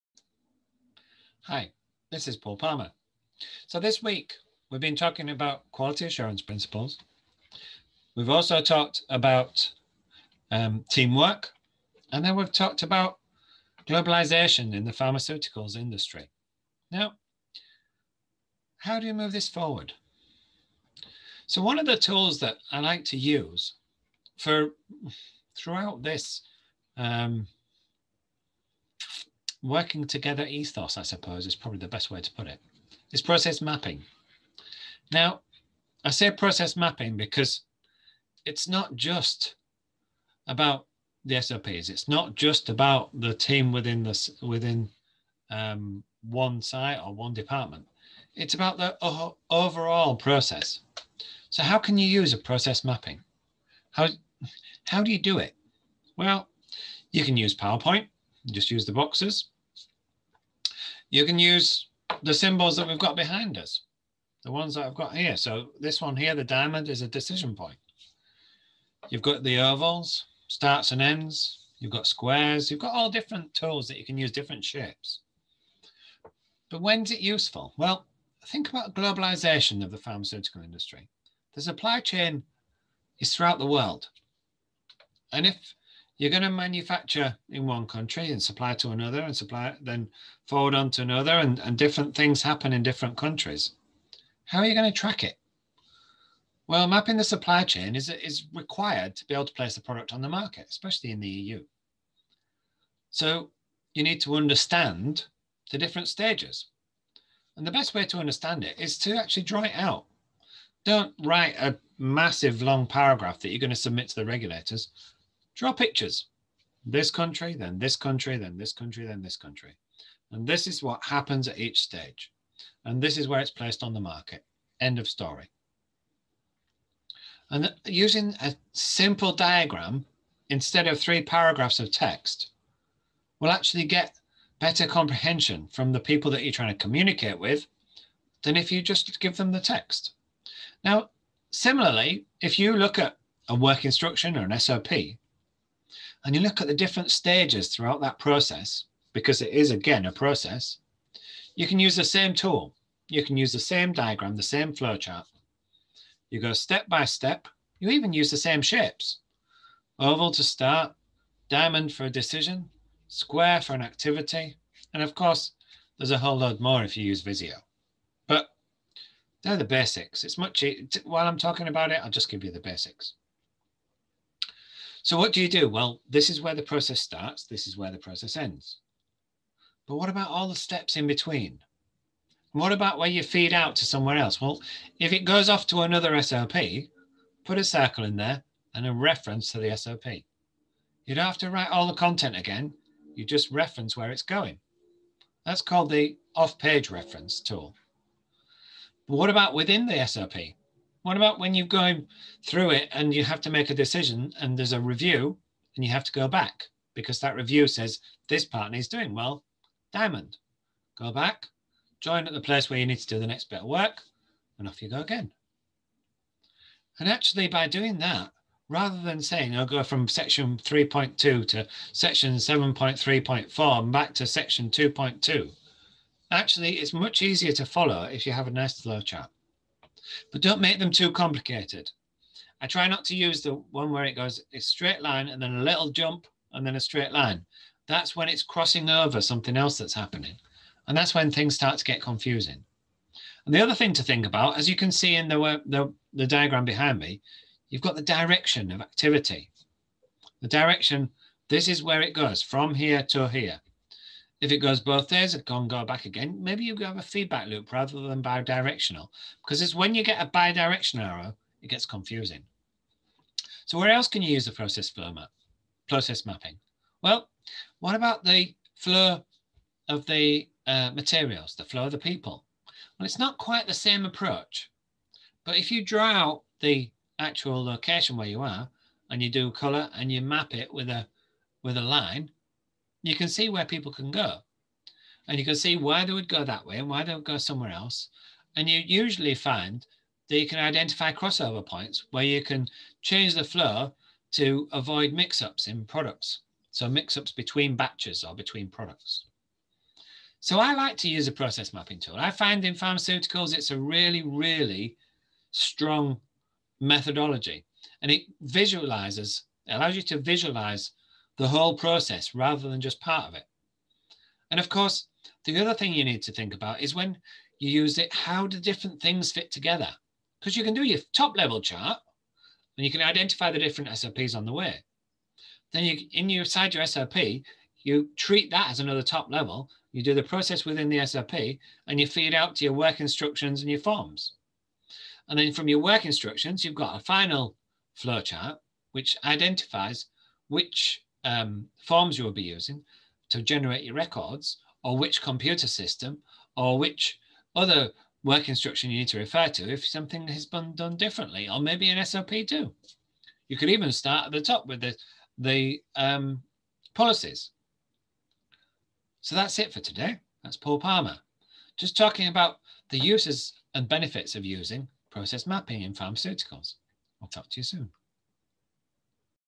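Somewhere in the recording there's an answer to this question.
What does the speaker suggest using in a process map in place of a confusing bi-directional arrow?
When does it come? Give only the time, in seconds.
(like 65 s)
257 s.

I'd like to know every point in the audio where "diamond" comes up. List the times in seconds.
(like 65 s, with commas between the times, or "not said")
66 s, 161 s, 209 s.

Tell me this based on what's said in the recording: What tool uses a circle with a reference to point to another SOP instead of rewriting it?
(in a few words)
Off-page reference tool.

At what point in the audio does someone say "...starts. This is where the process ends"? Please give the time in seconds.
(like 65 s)
176 s.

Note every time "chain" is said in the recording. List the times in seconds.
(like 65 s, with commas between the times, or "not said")
81 s, 97 s.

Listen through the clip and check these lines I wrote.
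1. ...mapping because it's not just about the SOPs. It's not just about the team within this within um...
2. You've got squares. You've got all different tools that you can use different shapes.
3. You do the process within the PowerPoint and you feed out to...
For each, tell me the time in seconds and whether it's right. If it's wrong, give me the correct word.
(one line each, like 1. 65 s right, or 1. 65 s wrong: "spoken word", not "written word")
1. 36 s right
2. 71 s right
3. 329 s wrong: "SOP", not "PowerPoint".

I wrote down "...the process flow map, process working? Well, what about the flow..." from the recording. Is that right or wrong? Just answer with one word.
wrong.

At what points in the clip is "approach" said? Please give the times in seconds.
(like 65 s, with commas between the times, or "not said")
274 s.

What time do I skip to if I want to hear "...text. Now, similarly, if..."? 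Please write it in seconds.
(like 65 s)
139 s.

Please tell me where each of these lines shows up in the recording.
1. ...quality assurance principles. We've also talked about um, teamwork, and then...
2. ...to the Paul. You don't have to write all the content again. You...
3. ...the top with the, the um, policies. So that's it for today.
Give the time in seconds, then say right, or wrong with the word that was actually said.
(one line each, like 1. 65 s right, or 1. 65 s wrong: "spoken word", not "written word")
1. 5 s right
2. 189 s wrong: "SOP", not "Paul"
3. 354 s right.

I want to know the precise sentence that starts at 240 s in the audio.
And that's when things start to get confusing.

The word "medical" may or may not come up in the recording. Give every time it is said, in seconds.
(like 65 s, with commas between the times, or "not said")
not said.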